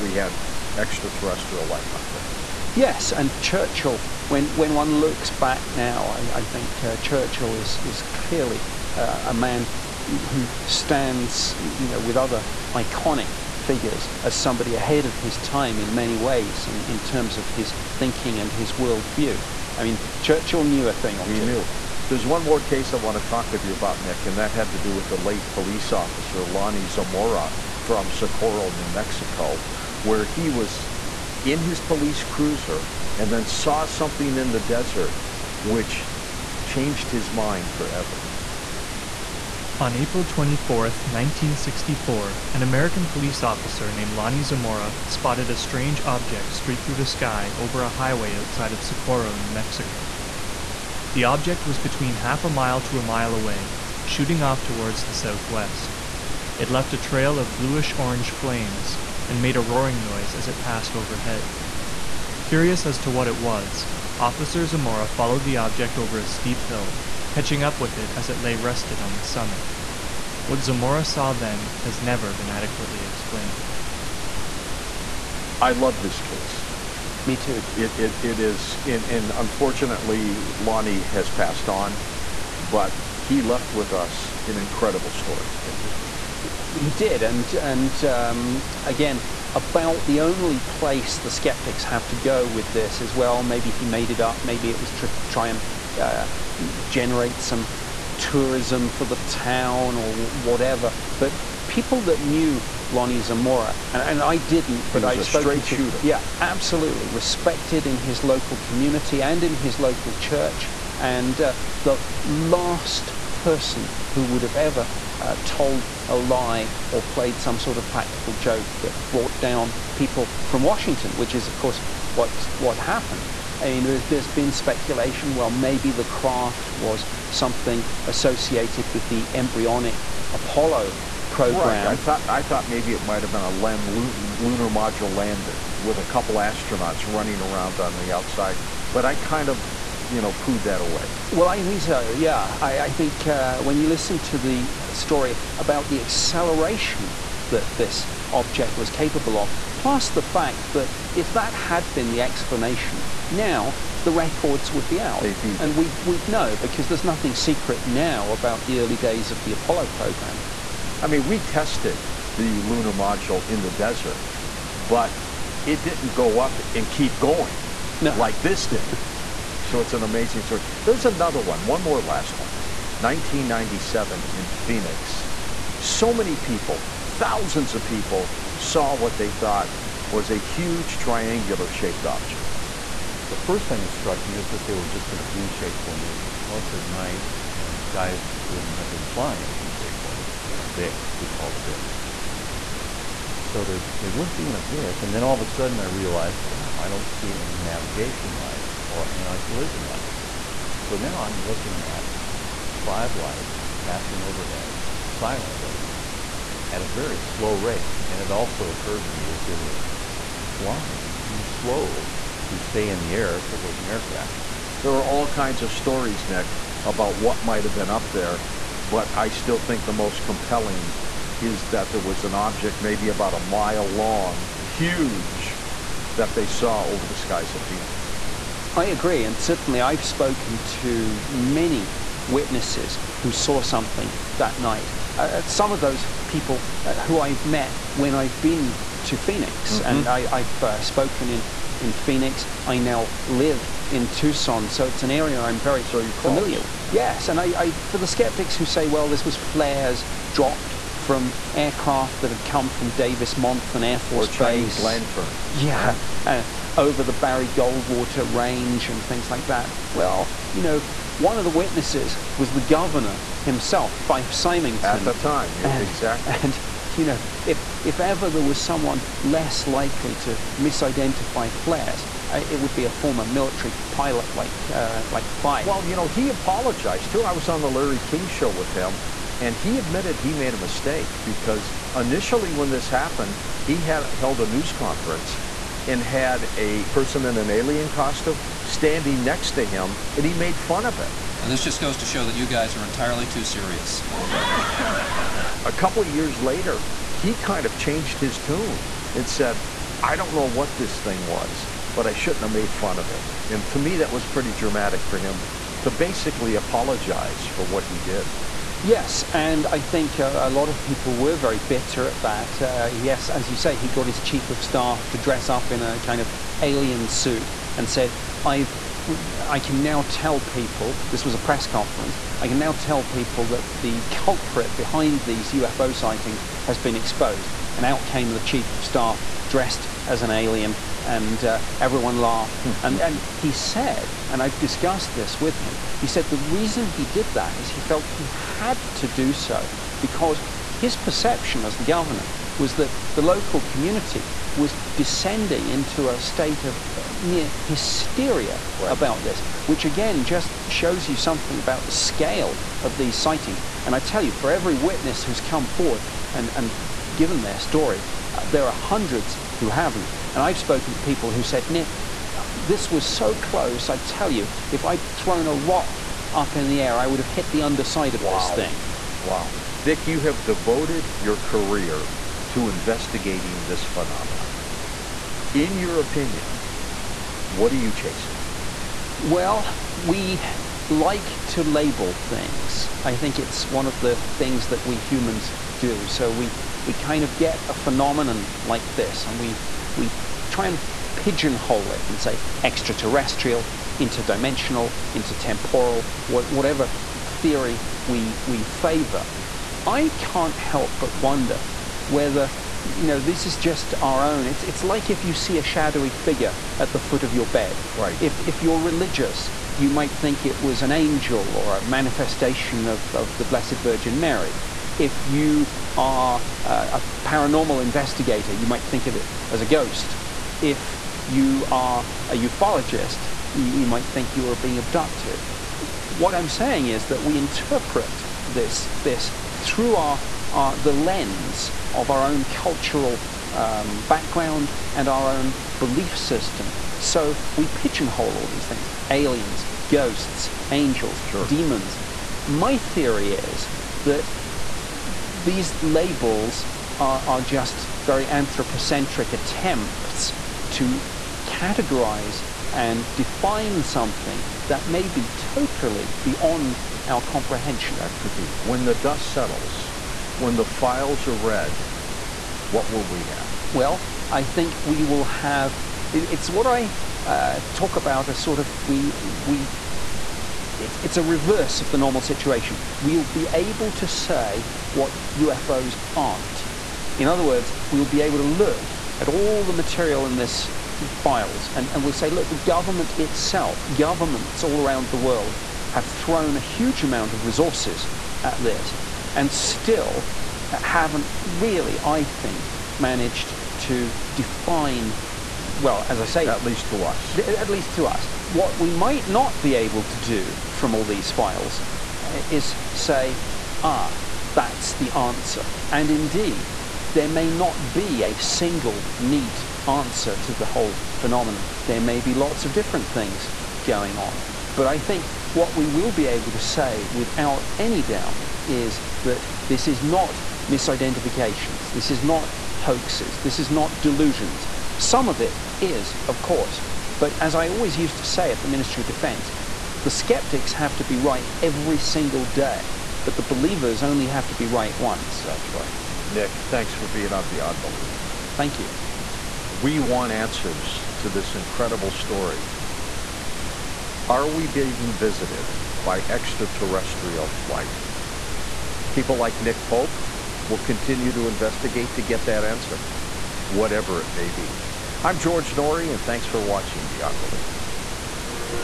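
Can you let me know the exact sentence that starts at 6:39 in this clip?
I can't help but wonder whether you know, this is just our own.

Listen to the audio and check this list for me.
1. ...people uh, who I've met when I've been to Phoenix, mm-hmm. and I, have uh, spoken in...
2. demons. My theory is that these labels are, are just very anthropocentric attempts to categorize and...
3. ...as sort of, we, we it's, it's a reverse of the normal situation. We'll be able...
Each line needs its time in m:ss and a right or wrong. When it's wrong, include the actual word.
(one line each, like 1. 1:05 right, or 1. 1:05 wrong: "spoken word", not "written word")
1. 3:56 right
2. 7:21 right
3. 7:48 right.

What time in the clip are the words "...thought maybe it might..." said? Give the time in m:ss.
2:12.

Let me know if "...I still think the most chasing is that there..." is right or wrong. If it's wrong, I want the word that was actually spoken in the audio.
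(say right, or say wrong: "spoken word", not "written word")
wrong: "compelling", not "chasing".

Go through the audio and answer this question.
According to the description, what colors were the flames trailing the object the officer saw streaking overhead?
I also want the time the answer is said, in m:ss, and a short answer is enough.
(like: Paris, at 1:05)
bluish orange, at 0:57.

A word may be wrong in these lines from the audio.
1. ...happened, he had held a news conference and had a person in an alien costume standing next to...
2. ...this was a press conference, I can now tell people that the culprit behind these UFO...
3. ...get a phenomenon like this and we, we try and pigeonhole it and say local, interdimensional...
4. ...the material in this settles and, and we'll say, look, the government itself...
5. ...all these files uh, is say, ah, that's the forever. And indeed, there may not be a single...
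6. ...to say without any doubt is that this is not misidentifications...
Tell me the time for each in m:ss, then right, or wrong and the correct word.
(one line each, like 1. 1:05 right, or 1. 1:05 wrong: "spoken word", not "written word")
1. 4:42 right
2. 5:21 right
3. 6:27 wrong: "extraterrestrial", not "local"
4. 7:59 wrong: "files", not "settles"
5. 8:20 wrong: "answer", not "forever"
6. 8:36 right.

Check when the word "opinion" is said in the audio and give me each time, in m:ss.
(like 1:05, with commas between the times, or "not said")
6:15.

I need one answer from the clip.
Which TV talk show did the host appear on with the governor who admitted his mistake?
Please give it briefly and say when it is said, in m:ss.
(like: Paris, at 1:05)
Larry King show, at 4:37.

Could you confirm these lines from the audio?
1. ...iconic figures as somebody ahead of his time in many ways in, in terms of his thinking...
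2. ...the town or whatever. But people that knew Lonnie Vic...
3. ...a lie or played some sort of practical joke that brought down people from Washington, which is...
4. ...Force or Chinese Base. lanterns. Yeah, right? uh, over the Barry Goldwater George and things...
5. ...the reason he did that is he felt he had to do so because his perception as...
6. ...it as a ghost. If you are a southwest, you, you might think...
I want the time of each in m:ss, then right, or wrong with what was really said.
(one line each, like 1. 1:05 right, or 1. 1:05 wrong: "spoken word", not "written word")
1. 0:12 right
2. 1:39 wrong: "Zamora", not "Vic"
3. 1:56 right
4. 4:13 wrong: "Range", not "George"
5. 5:36 right
6. 6:59 wrong: "ufologist", not "southwest".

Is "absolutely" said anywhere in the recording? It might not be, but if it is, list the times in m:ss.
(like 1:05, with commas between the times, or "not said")
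1:46.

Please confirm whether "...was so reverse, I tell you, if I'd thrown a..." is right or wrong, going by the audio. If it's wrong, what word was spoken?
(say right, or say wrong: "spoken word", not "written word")
wrong: "close", not "reverse".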